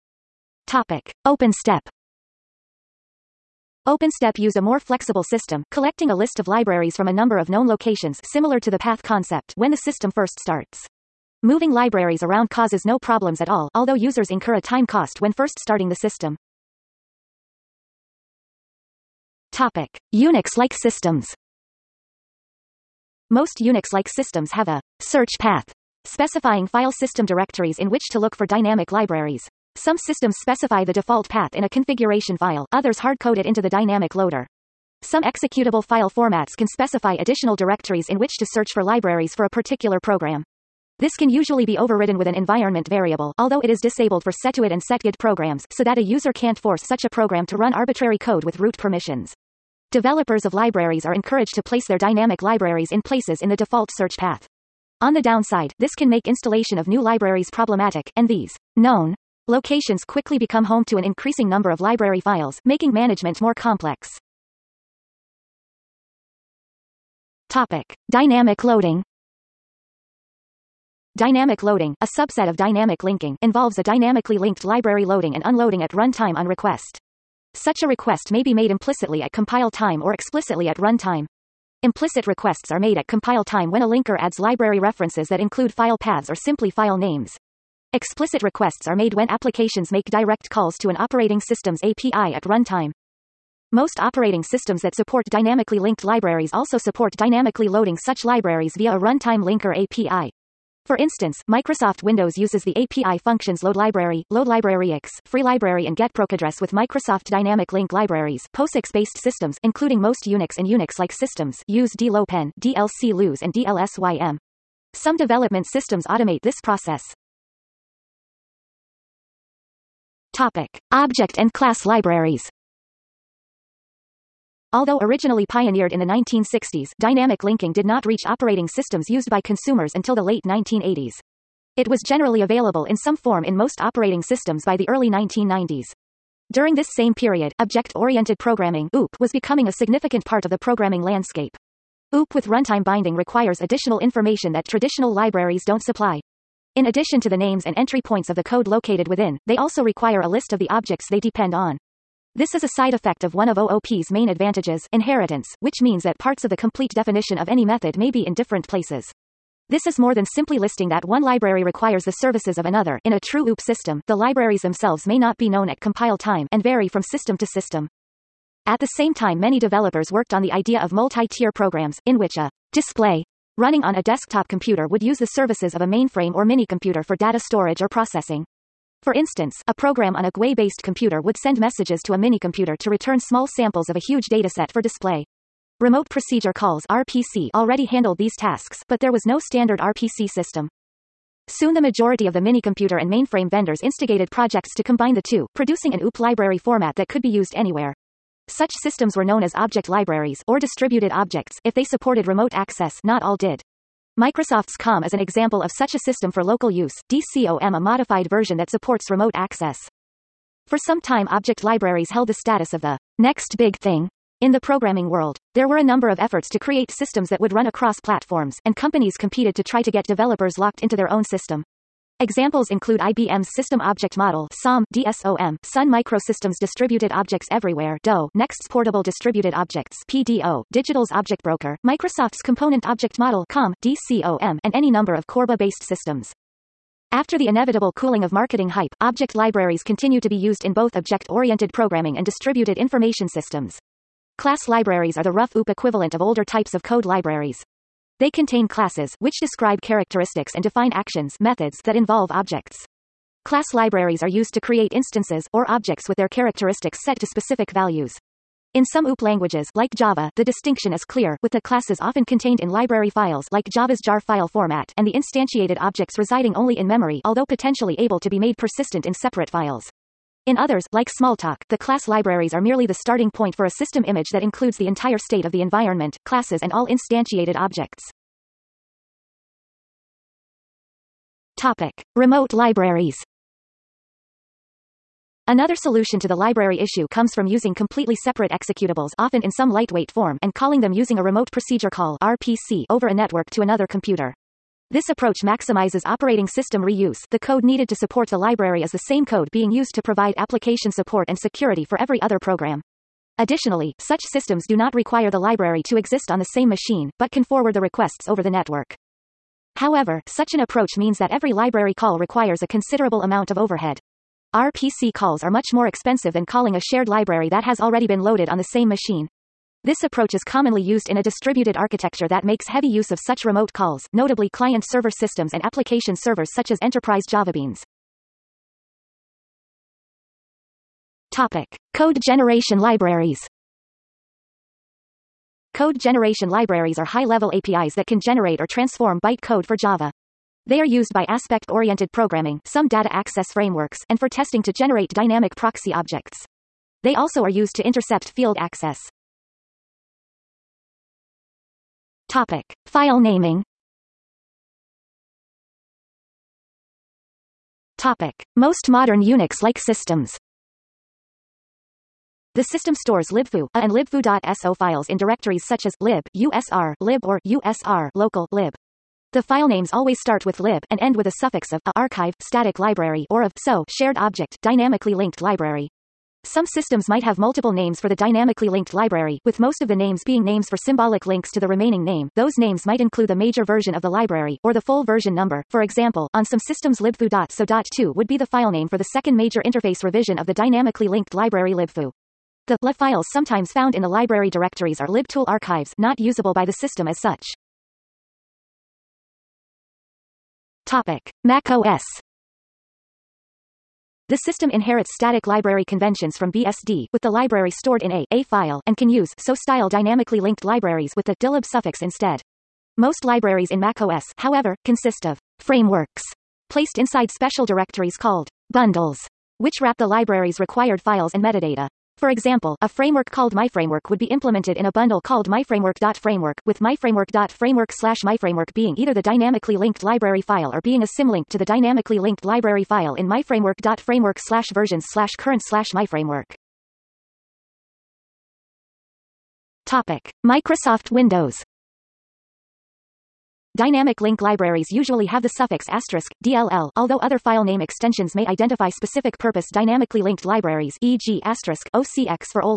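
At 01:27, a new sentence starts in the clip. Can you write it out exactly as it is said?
Explicit requests are made when applications make direct calls to an operating system's API at runtime.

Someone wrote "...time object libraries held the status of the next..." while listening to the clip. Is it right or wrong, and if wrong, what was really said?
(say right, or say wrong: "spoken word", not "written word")
right.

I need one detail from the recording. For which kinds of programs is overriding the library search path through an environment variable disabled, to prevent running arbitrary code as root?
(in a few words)
setuid and setgid programs.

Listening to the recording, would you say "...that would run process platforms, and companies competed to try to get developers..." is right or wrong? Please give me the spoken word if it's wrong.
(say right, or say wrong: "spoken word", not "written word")
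wrong: "across", not "process".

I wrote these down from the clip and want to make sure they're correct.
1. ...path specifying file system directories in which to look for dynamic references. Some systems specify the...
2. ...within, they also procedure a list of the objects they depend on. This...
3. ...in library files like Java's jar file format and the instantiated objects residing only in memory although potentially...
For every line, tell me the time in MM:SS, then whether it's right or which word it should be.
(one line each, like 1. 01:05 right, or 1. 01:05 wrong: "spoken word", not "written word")
1. 00:25 wrong: "libraries", not "references"
2. 02:29 wrong: "require", not "procedure"
3. 04:22 right.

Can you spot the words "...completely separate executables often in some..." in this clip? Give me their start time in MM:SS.
04:47.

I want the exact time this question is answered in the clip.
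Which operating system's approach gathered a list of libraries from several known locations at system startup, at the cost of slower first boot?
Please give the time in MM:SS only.
00:03.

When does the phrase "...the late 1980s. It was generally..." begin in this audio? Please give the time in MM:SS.
02:10.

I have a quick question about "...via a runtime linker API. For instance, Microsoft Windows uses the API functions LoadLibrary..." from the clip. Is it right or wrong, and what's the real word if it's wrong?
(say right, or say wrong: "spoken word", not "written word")
right.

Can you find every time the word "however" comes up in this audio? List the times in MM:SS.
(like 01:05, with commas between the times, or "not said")
05:09, 06:54.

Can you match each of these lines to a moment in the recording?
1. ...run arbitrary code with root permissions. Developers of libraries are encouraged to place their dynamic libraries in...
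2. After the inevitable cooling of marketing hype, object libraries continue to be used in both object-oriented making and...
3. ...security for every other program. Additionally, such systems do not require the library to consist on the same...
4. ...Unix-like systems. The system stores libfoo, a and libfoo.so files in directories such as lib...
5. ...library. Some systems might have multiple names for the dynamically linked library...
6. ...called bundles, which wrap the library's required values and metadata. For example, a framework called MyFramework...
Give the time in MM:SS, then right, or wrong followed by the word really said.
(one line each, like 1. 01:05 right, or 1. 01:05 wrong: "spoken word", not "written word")
1. 00:47 right
2. 03:57 wrong: "programming", not "making"
3. 05:01 wrong: "exist", not "consist"
4. 05:59 right
5. 06:15 right
6. 06:58 wrong: "files", not "values".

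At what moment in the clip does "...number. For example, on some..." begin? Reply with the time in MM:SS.
06:25.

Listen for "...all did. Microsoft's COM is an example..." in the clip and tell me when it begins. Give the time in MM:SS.
03:23.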